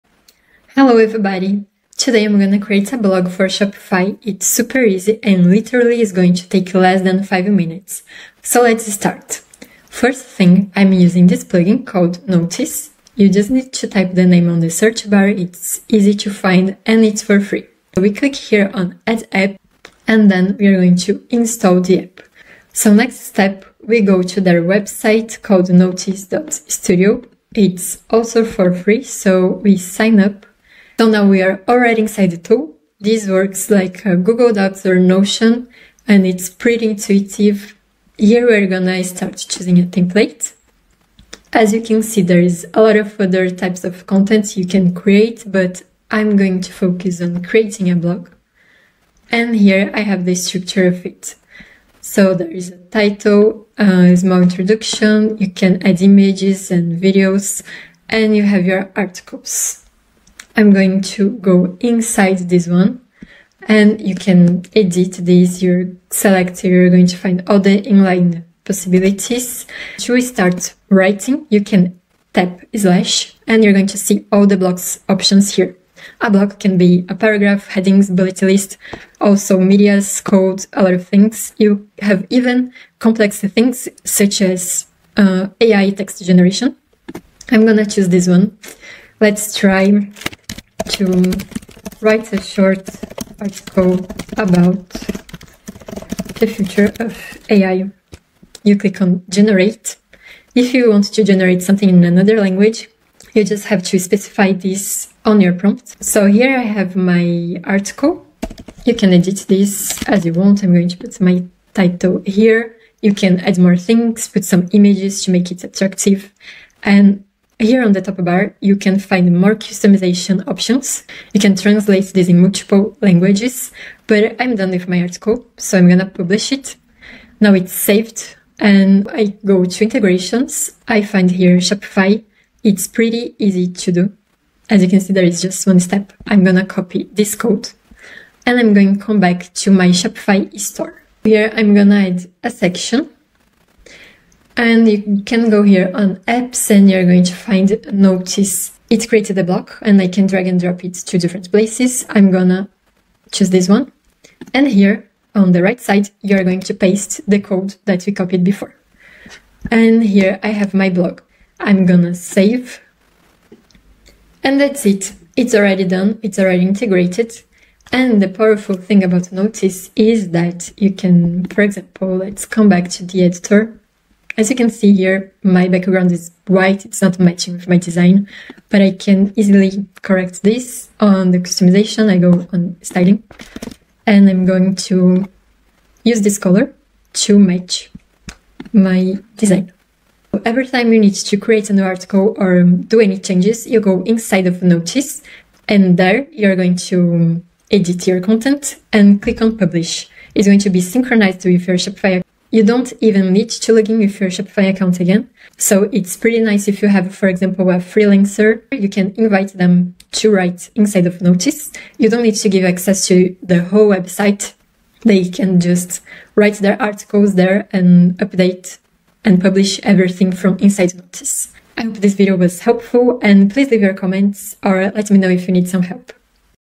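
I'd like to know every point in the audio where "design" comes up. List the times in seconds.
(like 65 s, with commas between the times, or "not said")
177 s, 189 s.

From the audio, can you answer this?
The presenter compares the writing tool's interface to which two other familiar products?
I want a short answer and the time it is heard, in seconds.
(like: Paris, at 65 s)
Google Docs or Notion, at 34 s.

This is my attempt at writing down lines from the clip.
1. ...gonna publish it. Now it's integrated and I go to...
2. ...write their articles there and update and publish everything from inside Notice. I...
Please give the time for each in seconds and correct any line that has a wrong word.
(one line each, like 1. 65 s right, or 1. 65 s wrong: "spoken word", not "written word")
1. 125 s wrong: "saved", not "integrated"
2. 216 s right.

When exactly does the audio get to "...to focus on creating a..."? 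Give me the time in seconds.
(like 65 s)
46 s.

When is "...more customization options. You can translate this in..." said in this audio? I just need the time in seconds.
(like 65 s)
119 s.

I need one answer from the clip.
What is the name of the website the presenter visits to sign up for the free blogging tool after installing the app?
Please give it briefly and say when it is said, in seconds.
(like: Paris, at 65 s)
notice.studio, at 25 s.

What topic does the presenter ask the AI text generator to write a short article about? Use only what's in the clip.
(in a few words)
the future of AI.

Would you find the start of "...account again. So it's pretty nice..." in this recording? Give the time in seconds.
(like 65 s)
204 s.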